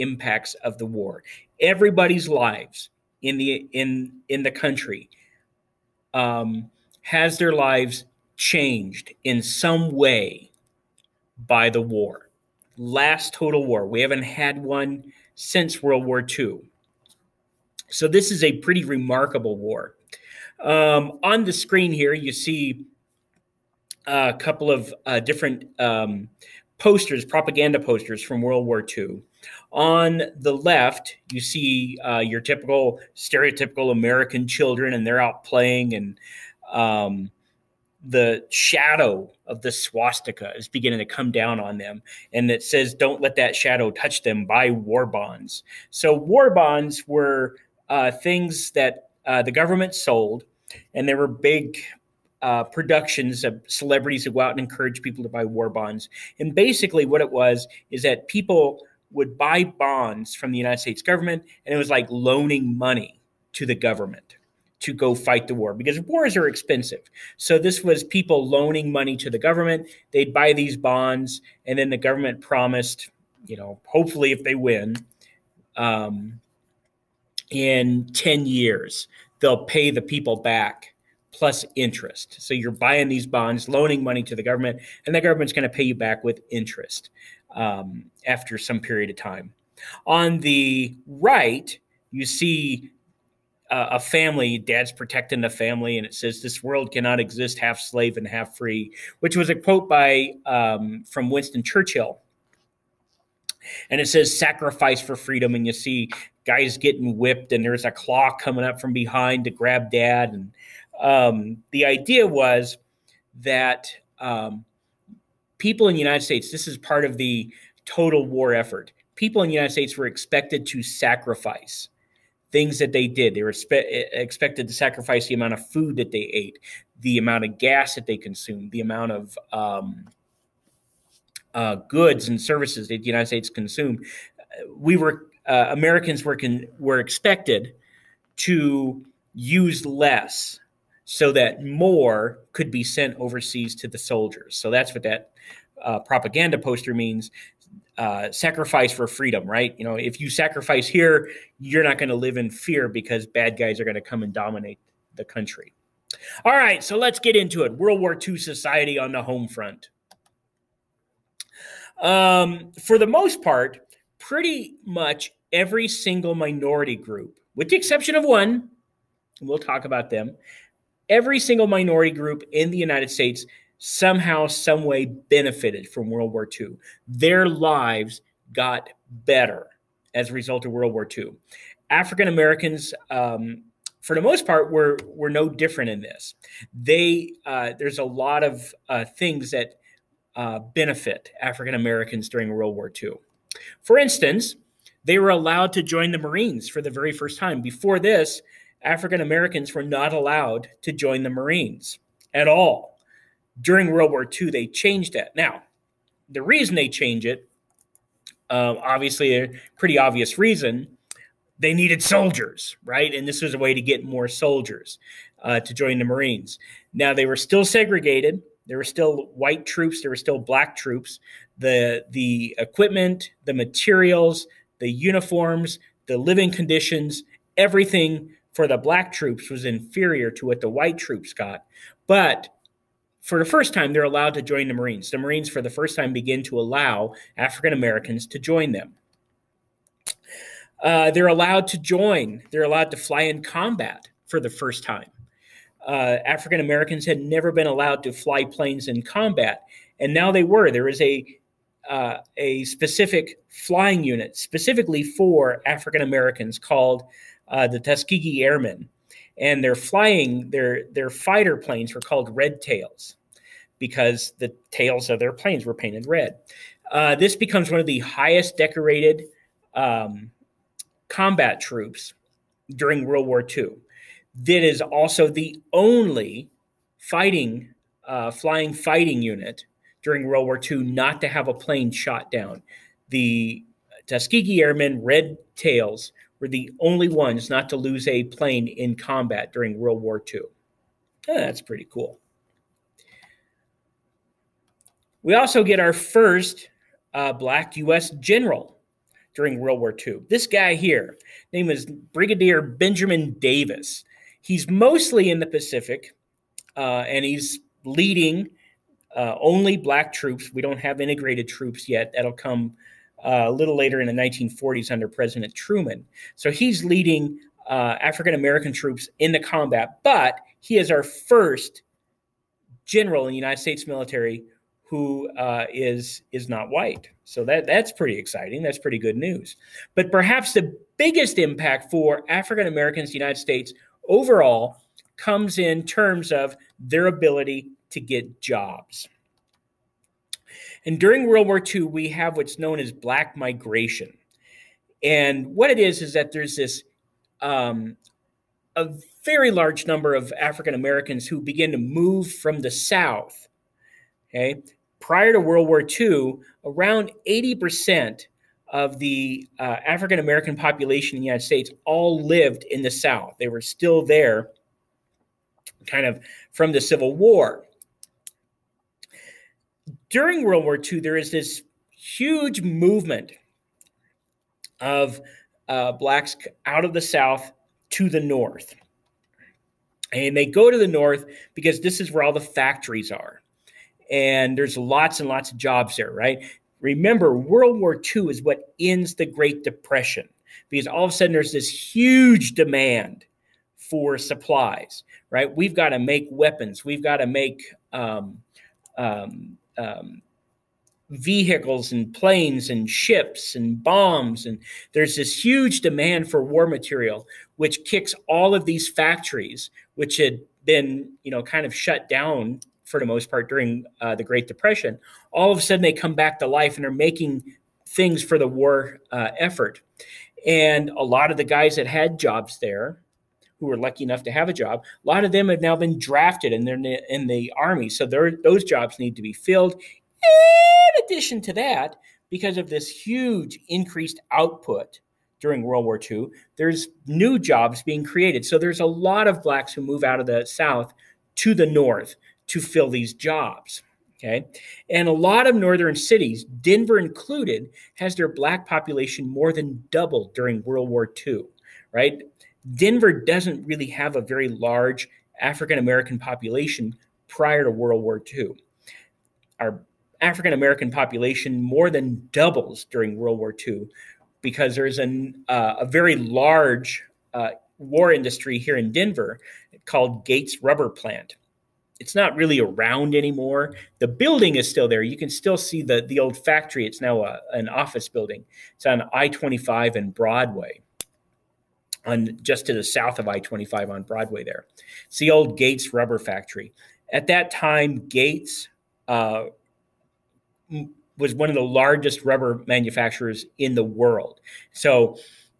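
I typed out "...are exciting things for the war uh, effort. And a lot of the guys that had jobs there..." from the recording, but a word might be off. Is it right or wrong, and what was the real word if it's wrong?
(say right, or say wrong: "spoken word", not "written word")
wrong: "making", not "exciting".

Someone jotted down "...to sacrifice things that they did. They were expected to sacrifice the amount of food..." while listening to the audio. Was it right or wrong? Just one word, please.
right.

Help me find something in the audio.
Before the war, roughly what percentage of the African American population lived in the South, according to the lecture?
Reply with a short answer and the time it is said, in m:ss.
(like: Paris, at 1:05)
80%, at 5:57.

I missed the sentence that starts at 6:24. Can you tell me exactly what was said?
And there's lots and lots of jobs there, right?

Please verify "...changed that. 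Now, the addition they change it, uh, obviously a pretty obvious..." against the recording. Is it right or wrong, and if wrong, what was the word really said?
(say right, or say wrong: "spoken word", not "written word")
wrong: "reason", not "addition".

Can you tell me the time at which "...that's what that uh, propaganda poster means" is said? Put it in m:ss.
2:24.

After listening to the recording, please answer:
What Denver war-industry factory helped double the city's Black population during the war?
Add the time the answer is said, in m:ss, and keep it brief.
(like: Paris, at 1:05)
Gates Rubber Plant, at 7:50.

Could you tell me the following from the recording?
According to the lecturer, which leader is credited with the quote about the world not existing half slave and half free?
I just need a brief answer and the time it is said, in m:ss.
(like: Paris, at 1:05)
Winston Churchill, at 1:41.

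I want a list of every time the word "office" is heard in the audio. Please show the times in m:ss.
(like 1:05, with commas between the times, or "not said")
7:57.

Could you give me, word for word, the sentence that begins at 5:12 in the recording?
That'll come uh, a little later in the 1940s under President Truman.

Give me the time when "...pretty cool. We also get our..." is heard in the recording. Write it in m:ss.
4:51.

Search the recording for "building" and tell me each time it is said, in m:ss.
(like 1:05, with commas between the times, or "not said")
7:54, 7:58.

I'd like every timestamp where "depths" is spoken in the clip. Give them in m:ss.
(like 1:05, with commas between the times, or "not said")
not said.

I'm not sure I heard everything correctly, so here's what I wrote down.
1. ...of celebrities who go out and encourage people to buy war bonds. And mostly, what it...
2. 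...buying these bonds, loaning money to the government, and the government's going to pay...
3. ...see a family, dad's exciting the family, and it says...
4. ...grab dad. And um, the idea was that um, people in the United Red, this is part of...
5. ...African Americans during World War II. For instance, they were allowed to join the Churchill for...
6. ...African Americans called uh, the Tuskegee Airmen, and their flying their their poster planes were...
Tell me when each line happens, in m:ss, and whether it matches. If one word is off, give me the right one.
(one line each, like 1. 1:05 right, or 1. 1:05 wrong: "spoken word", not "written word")
1. 0:53 wrong: "basically", not "mostly"
2. 1:22 right
3. 1:32 wrong: "protecting", not "exciting"
4. 1:49 wrong: "States", not "Red"
5. 3:11 wrong: "Marines", not "Churchill"
6. 4:15 wrong: "fighter", not "poster".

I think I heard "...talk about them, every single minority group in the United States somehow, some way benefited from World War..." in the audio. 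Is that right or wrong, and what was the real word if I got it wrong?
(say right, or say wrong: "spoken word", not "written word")
right.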